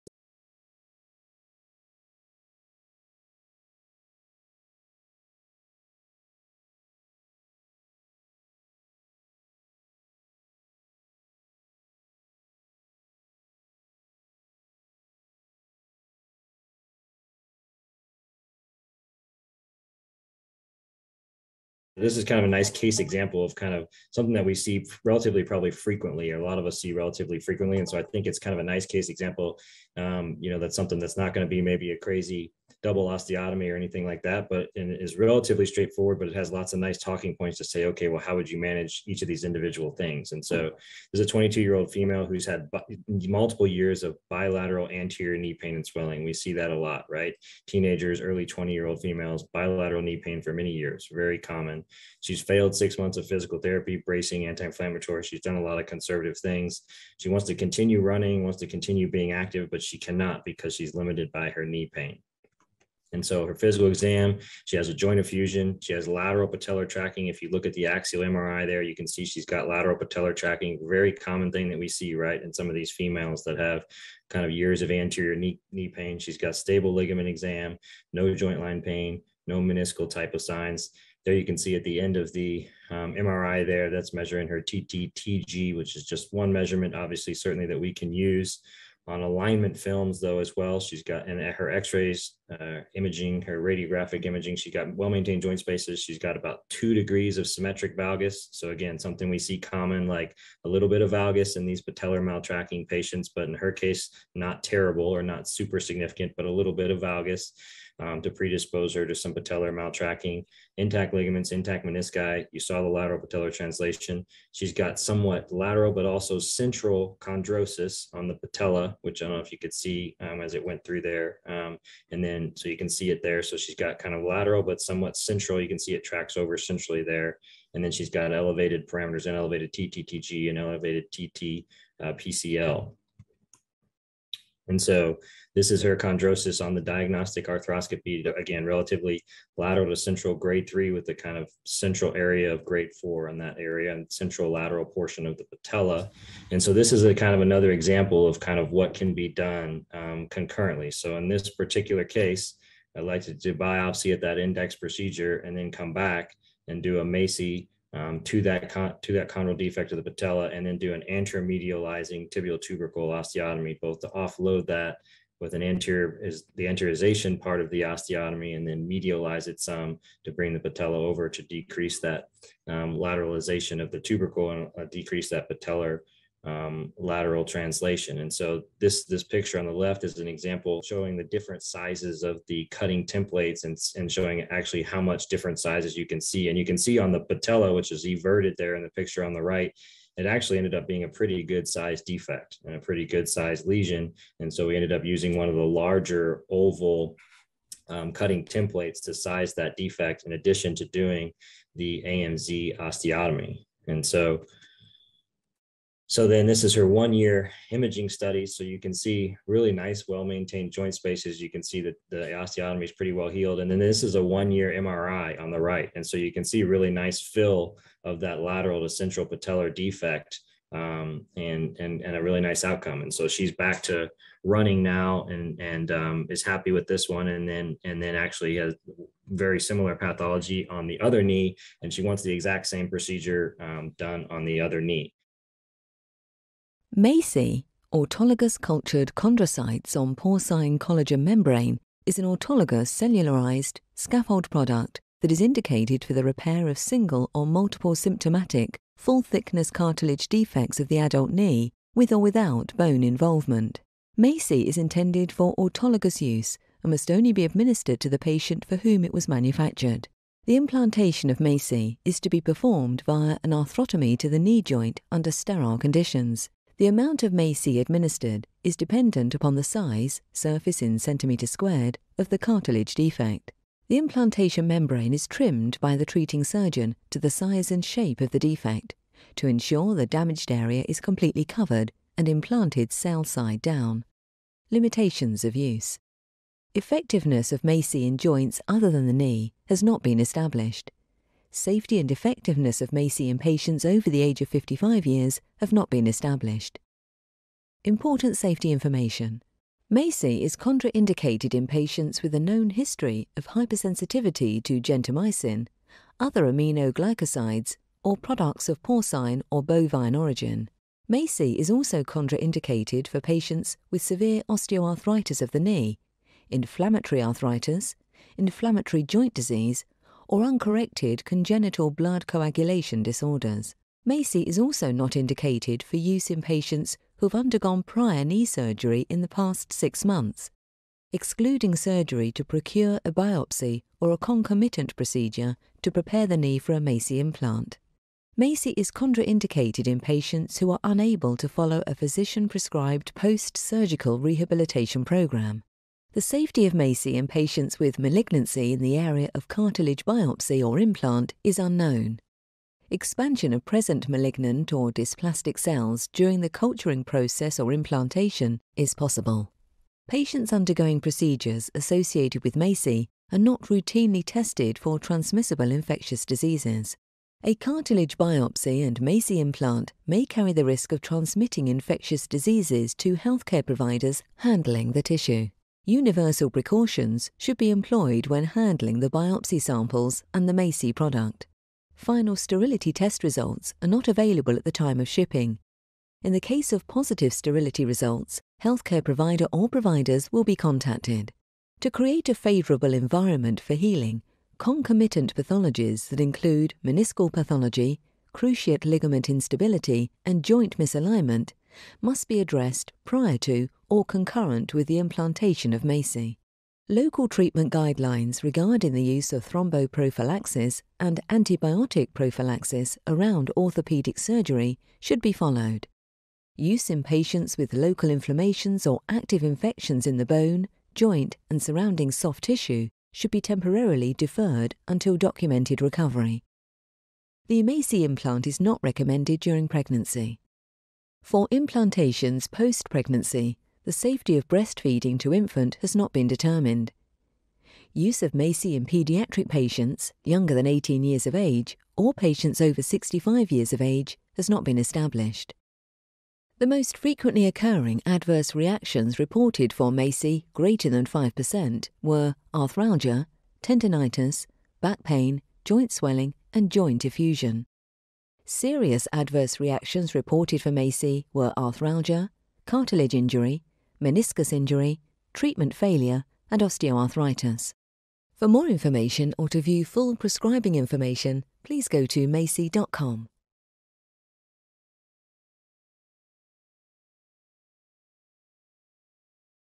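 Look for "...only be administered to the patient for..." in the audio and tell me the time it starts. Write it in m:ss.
4:17.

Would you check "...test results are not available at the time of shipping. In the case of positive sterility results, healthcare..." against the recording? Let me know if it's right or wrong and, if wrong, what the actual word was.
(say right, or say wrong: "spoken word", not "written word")
right.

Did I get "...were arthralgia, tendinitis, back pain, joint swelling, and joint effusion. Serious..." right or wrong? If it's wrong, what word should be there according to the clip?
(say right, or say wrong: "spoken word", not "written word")
right.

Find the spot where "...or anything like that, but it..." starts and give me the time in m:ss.
0:33.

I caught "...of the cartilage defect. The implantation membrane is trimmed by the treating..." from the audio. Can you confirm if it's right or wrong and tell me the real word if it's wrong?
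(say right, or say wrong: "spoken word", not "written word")
right.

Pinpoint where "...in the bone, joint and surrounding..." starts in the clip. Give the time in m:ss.
7:00.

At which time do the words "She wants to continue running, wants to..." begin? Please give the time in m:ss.
0:57.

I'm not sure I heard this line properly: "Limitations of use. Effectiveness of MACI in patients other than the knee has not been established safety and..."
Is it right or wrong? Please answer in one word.
wrong.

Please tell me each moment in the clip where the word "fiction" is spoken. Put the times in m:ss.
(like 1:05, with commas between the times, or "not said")
not said.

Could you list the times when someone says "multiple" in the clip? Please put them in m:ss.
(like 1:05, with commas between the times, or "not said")
0:43, 4:07.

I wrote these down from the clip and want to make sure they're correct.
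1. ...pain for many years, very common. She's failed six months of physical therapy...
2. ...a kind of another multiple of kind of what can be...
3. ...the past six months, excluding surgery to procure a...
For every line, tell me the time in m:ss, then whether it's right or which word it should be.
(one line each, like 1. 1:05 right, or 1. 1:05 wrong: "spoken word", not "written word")
1. 0:50 right
2. 2:27 wrong: "example", not "multiple"
3. 5:29 right.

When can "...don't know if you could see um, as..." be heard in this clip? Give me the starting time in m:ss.
1:59.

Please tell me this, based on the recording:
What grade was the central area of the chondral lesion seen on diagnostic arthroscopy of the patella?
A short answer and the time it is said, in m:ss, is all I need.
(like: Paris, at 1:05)
grade 4, at 2:22.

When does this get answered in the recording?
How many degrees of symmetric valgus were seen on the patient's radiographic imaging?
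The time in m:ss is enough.
1:36.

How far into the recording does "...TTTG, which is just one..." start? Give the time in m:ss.
1:24.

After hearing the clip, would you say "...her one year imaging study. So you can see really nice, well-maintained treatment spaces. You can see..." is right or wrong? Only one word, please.
wrong.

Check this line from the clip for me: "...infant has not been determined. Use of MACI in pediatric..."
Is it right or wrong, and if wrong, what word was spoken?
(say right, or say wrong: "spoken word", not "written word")
right.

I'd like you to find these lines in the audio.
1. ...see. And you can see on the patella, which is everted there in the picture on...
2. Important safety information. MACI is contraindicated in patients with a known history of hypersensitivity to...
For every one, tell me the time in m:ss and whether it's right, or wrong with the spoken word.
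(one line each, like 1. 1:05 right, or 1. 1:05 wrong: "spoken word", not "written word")
1. 3:06 right
2. 4:57 right.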